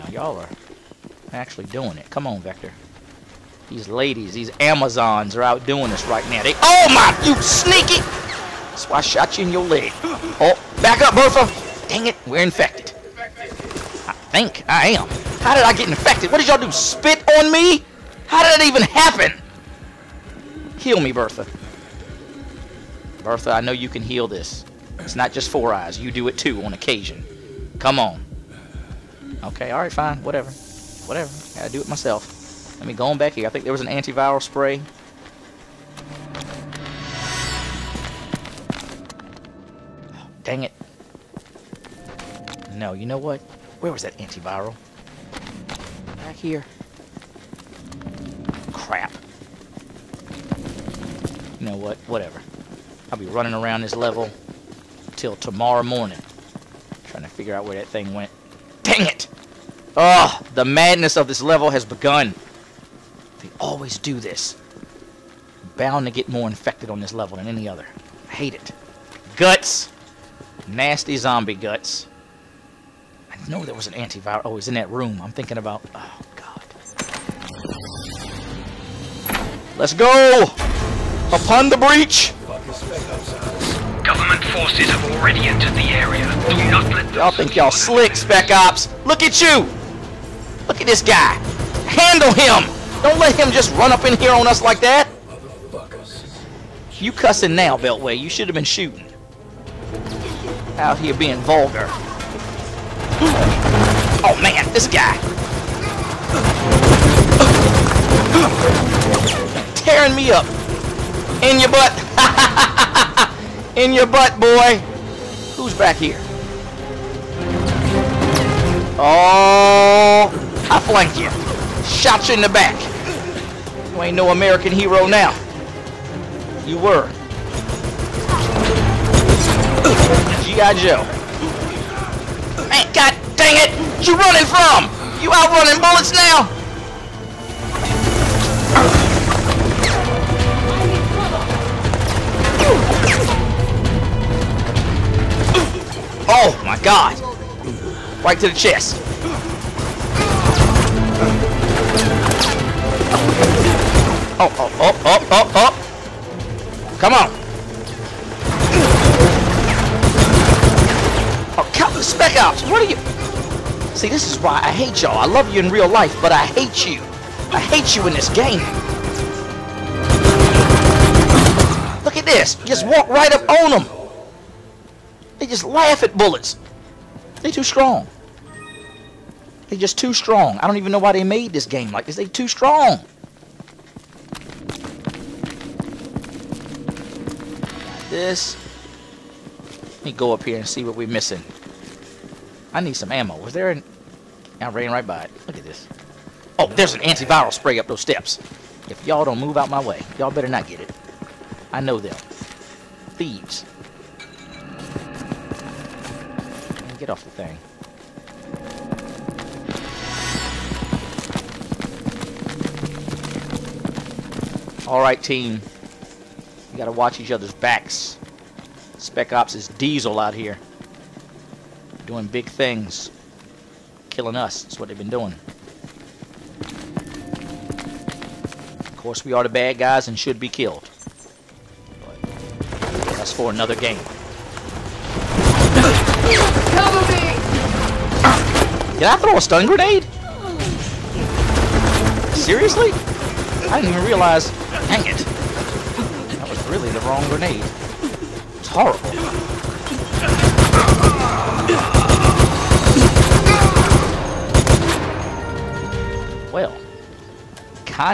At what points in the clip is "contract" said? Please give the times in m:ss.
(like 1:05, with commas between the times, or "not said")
not said.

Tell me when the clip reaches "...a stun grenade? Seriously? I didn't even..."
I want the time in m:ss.
3:59.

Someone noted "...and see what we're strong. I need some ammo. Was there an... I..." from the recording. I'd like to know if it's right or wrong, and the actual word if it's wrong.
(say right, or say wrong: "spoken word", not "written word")
wrong: "missing", not "strong".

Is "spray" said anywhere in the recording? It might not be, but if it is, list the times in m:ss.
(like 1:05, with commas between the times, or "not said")
0:34, 3:17.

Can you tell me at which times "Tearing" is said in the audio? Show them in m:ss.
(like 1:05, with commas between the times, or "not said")
1:49.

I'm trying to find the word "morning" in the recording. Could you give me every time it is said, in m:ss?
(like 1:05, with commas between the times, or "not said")
0:55.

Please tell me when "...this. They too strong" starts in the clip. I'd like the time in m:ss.
3:02.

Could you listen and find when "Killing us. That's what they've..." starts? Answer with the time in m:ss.
3:44.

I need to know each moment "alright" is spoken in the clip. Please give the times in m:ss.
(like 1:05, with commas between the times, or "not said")
0:29, 3:34.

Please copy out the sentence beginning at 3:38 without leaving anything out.
Spec Ops is diesel out here.